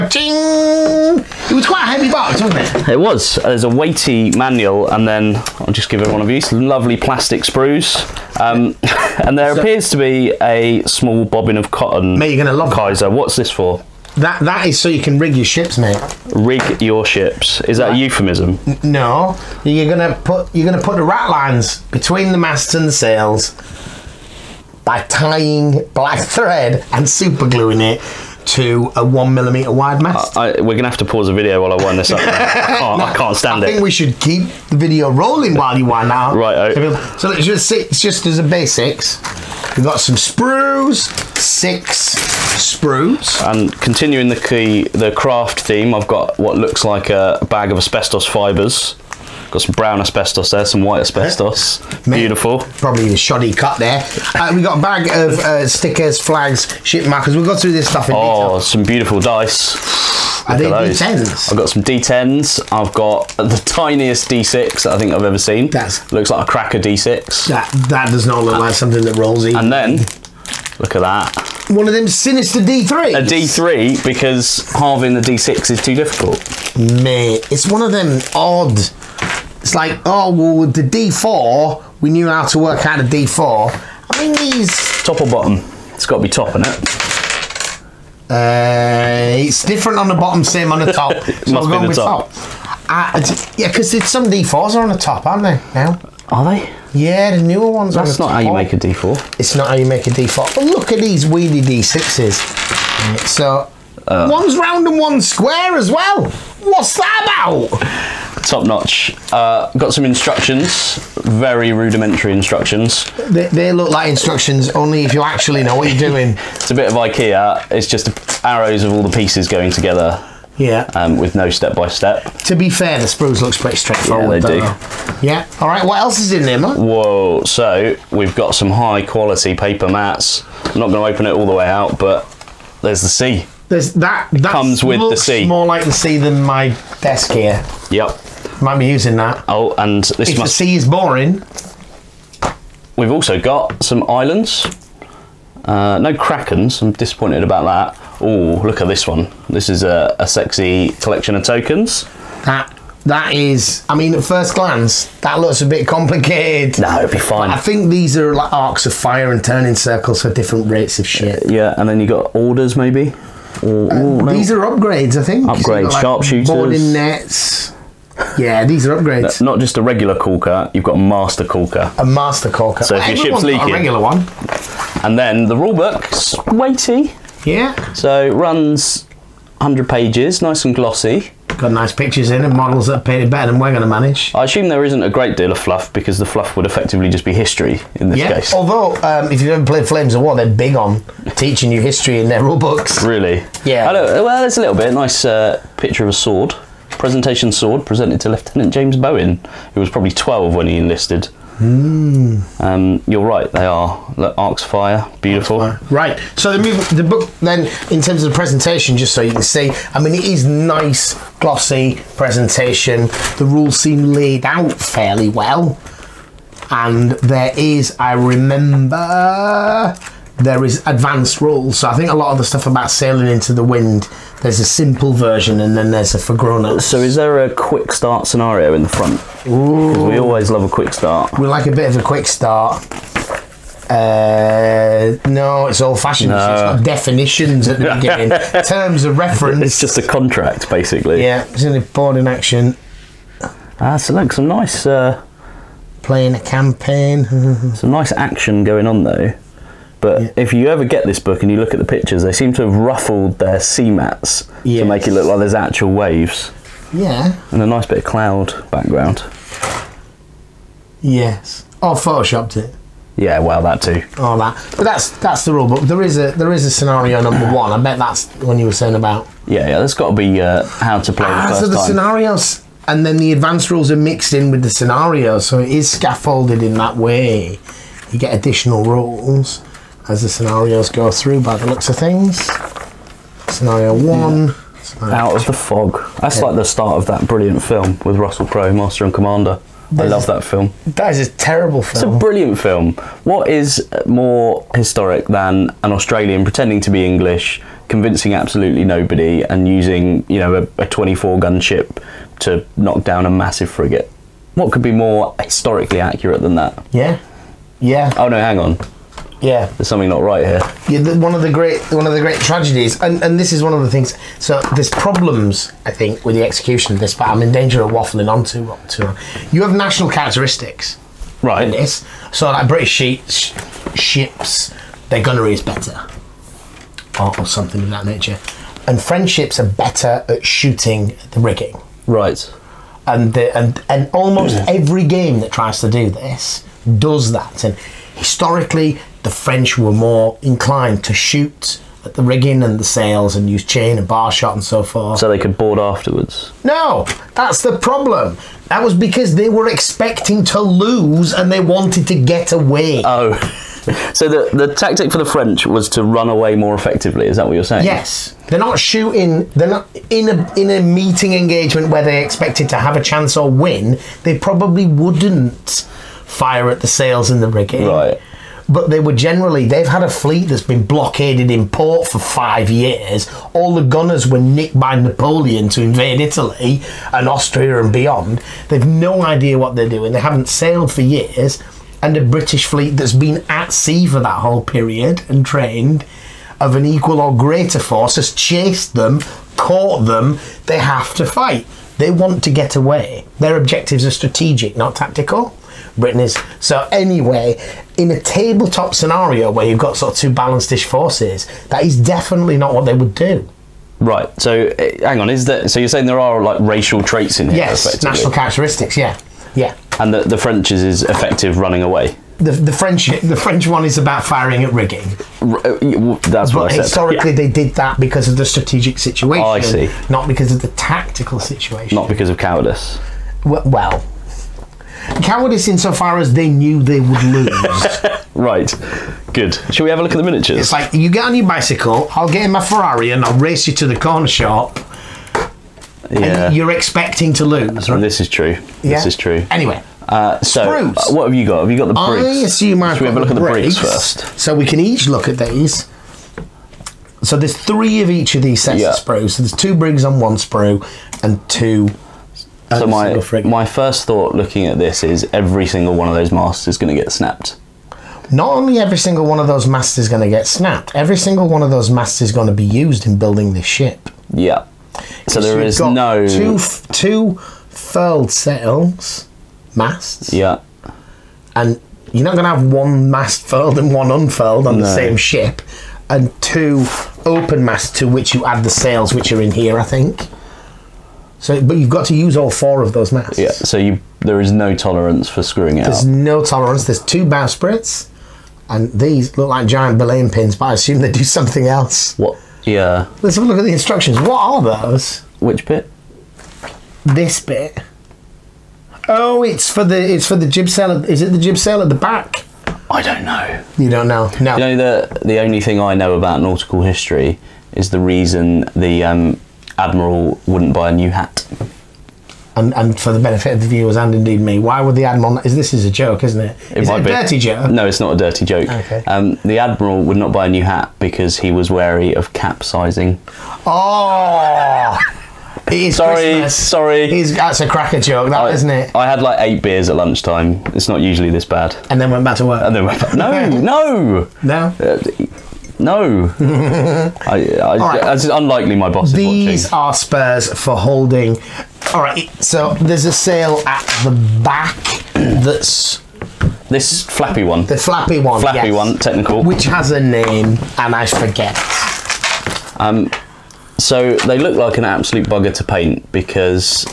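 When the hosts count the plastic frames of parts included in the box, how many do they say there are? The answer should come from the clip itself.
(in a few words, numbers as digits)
6.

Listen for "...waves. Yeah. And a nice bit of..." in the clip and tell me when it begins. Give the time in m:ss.
4:15.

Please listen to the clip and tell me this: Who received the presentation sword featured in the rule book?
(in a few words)
Lieutenant James Bowen.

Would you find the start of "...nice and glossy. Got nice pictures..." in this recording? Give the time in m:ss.
3:00.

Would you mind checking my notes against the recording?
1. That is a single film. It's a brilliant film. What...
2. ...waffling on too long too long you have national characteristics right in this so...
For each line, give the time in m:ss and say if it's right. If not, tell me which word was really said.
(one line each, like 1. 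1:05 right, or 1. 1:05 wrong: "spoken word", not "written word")
1. 4:50 wrong: "terrible", not "single"
2. 5:17 right.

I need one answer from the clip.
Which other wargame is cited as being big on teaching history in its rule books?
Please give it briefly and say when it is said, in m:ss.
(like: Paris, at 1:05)
Flames of War, at 3:09.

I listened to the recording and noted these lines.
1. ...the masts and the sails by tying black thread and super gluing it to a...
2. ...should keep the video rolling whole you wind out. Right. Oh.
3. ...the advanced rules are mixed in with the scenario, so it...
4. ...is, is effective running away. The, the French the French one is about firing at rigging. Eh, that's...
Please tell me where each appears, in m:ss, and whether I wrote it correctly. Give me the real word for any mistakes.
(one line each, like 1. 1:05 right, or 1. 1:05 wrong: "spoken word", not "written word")
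1. 0:22 right
2. 0:33 wrong: "while", not "whole"
3. 4:33 right
4. 6:50 right.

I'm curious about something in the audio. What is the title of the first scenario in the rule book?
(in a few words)
Out of the fog.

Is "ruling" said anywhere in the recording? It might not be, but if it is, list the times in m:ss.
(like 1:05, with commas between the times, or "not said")
not said.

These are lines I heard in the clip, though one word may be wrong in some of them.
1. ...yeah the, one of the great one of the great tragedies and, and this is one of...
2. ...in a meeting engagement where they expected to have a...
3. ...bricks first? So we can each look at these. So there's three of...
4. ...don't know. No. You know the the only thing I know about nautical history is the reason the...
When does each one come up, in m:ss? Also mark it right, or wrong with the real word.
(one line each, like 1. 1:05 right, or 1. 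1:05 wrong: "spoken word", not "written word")
1. 5:10 right
2. 6:00 right
3. 7:23 right
4. 8:23 right.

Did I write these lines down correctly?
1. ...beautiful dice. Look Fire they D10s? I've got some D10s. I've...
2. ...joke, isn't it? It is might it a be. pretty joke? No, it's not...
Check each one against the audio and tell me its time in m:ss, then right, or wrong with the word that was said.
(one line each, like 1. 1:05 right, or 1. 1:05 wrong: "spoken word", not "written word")
1. 0:58 wrong: "Are", not "Fire"
2. 8:35 wrong: "dirty", not "pretty".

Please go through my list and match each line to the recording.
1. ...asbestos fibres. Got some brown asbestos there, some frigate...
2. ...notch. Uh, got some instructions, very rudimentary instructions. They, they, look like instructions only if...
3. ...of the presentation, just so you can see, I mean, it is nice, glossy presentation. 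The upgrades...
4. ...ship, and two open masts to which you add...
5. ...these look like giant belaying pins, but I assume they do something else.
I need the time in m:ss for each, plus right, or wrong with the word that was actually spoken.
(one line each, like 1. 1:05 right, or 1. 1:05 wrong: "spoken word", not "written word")
1. 0:47 wrong: "white", not "frigate"
2. 1:48 right
3. 3:28 wrong: "rules", not "upgrades"
4. 7:55 right
5. 8:08 right.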